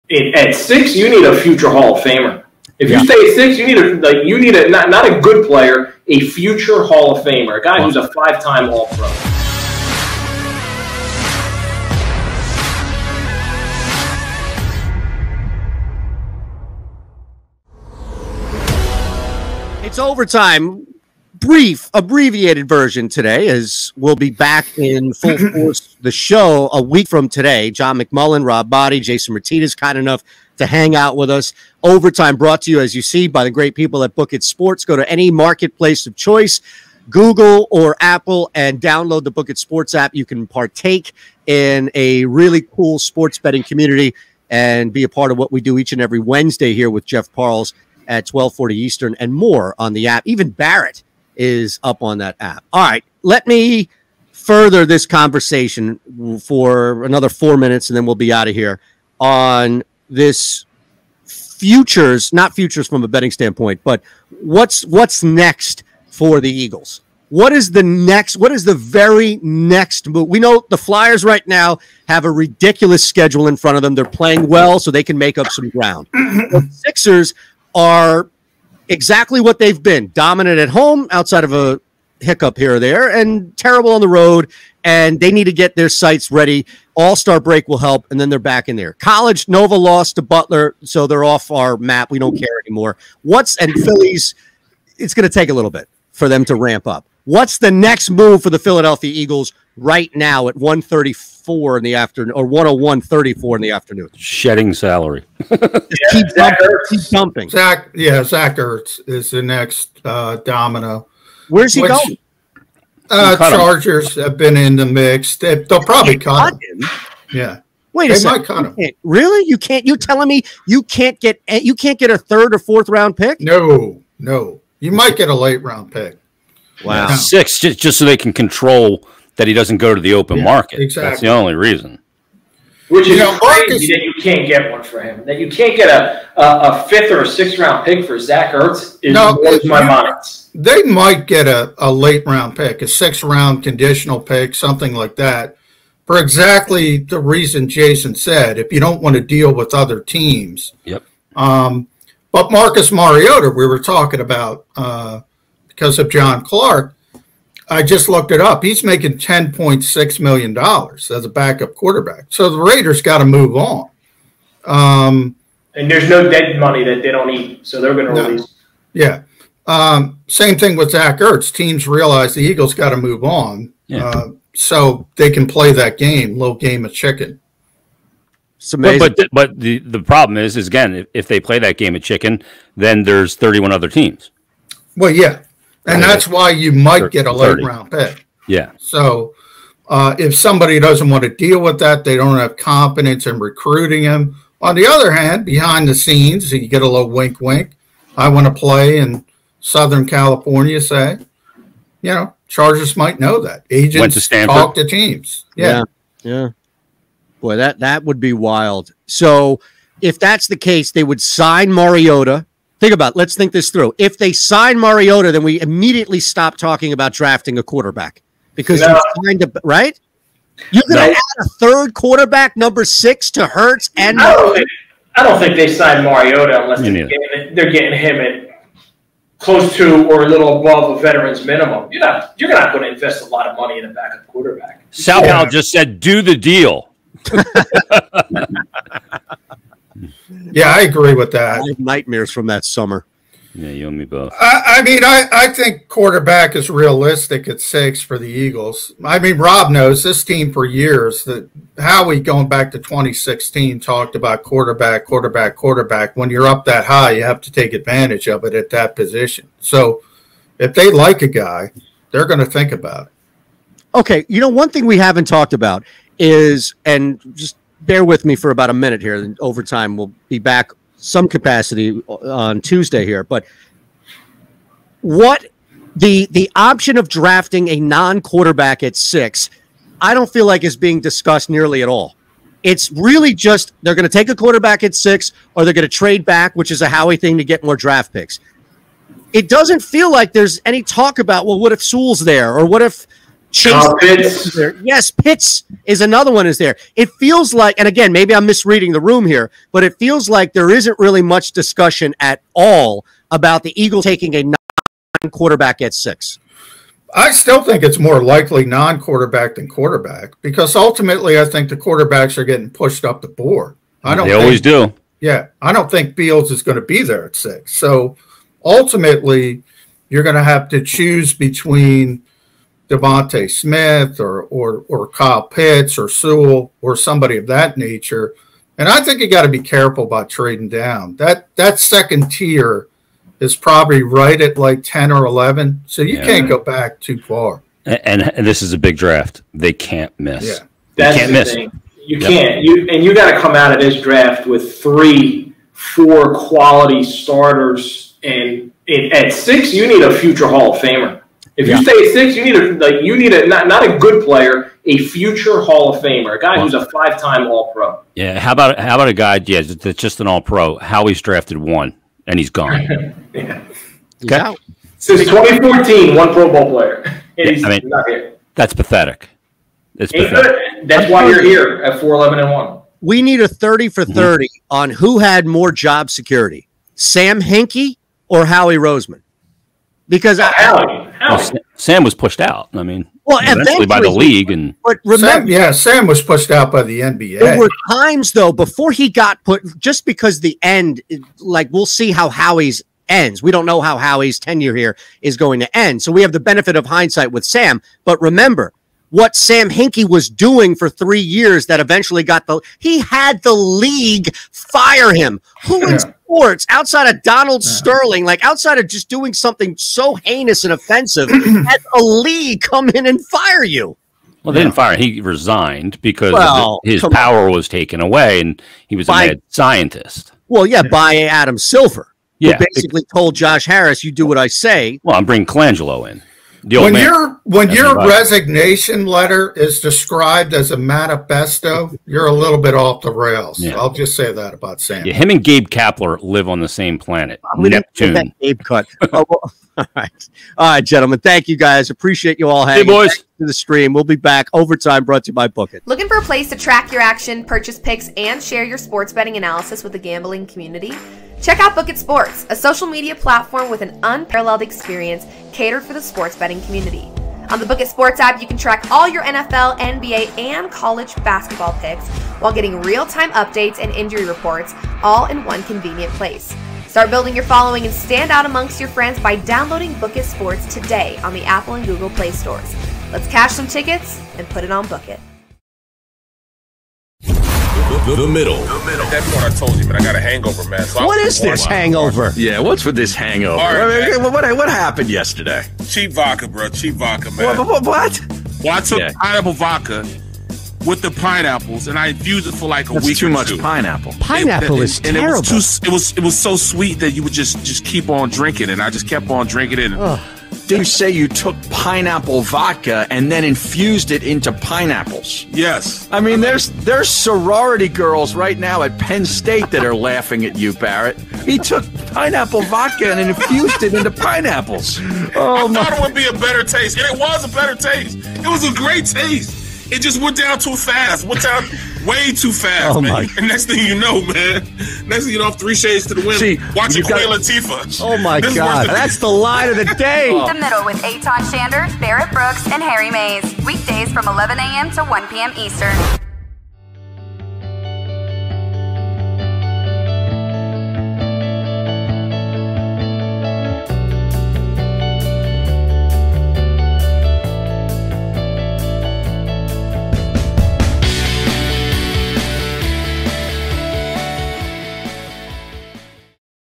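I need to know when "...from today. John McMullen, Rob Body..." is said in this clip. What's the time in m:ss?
0:27.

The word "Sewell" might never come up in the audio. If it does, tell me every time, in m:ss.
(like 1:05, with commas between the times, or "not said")
4:51, 5:26.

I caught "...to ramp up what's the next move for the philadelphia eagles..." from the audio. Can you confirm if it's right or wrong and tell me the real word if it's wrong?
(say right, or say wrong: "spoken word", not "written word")
right.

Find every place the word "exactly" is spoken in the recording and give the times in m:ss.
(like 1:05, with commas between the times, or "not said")
1:18, 2:10, 2:26.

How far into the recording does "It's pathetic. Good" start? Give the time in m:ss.
6:09.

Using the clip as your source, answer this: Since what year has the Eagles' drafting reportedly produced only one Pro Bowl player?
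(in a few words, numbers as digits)
2014.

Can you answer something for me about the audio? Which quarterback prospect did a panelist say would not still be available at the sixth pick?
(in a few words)
Beals.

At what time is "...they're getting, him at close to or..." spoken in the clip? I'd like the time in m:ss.
3:47.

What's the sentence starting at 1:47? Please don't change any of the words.
Zach, yeah, Zach Ertz is the next uh, domino.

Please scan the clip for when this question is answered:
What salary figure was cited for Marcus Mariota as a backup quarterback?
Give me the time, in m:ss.
2:39.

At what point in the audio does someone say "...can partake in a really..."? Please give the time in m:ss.
0:40.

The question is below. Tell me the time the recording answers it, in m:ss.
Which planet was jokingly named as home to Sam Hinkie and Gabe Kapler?
7:17.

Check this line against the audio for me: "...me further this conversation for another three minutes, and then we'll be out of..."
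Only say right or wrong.
wrong.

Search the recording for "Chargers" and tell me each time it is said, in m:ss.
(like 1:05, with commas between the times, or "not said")
1:53, 3:22.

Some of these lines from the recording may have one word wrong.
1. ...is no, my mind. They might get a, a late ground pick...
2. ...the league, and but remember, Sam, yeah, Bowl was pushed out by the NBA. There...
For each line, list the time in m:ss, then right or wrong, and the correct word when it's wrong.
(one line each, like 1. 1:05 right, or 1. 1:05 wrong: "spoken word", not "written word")
1. 2:19 wrong: "round", not "ground"
2. 6:24 wrong: "Sam", not "Bowl".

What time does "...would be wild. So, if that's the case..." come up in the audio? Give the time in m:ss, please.
3:28.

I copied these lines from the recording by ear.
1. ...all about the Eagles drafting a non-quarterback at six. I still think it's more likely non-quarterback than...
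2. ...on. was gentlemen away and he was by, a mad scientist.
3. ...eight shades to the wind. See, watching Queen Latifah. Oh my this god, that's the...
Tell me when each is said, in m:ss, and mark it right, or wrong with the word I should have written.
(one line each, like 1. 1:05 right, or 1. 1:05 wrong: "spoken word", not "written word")
1. 5:02 wrong: "taking", not "drafting"
2. 6:57 wrong: "taken", not "gentlemen"
3. 8:45 wrong: "three", not "eight".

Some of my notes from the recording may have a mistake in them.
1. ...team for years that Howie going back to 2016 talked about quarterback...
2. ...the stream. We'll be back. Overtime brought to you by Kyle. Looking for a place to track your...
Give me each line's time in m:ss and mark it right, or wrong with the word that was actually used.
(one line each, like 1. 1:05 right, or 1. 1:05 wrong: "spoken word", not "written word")
1. 4:10 right
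2. 7:23 wrong: "Bookit", not "Kyle".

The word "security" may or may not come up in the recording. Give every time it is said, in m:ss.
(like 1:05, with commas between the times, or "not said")
6:16.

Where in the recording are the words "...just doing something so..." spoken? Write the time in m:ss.
6:48.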